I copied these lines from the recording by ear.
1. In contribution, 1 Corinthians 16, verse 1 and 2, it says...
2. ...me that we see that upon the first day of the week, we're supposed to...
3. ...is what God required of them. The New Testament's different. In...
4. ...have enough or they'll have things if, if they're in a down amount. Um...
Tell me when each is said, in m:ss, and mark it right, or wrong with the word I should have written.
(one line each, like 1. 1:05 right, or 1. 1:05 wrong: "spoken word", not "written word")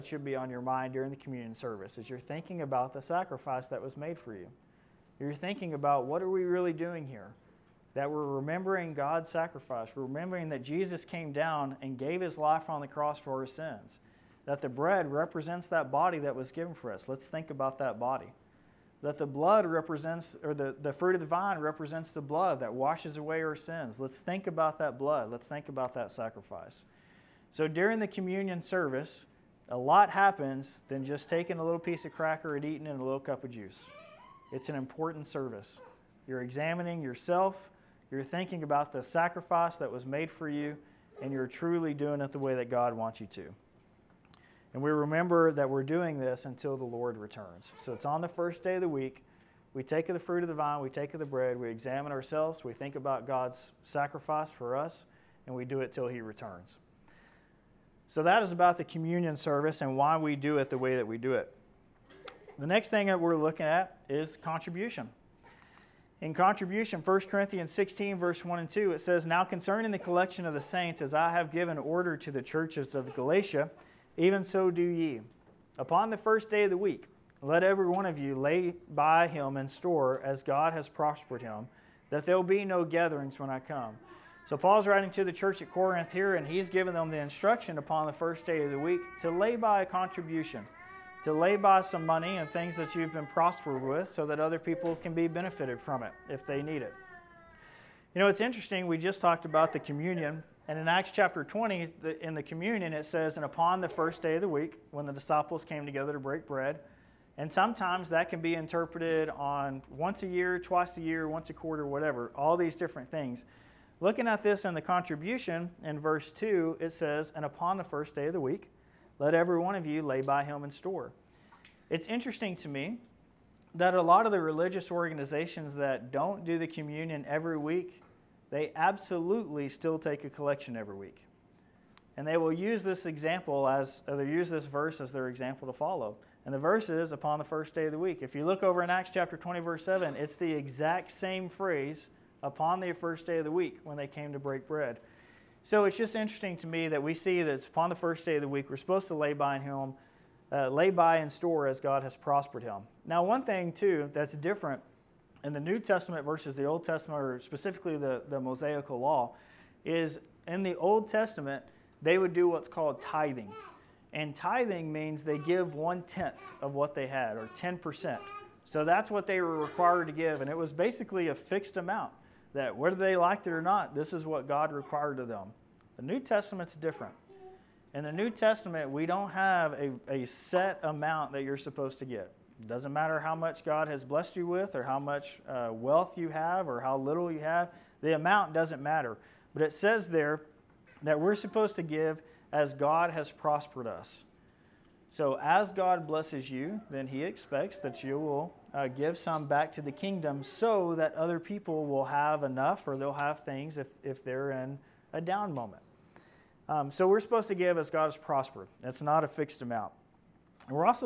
1. 1:06 right
2. 2:26 right
3. 2:54 right
4. 3:22 wrong: "moment", not "amount".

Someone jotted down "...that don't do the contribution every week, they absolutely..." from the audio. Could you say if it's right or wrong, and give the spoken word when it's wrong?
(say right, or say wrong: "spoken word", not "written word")
wrong: "communion", not "contribution".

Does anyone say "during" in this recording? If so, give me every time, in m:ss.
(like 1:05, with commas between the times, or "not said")
0:00, 0:27.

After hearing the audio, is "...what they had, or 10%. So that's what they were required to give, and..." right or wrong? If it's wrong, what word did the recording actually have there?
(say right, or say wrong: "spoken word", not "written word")
right.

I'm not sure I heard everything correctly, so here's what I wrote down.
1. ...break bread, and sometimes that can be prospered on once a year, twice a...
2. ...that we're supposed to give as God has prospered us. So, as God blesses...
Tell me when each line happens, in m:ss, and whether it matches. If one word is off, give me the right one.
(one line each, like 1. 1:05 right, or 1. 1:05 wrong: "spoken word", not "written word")
1. 1:46 wrong: "interpreted", not "prospered"
2. 3:11 right.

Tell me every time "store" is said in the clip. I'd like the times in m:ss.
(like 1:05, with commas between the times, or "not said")
1:19, 2:00, 2:31.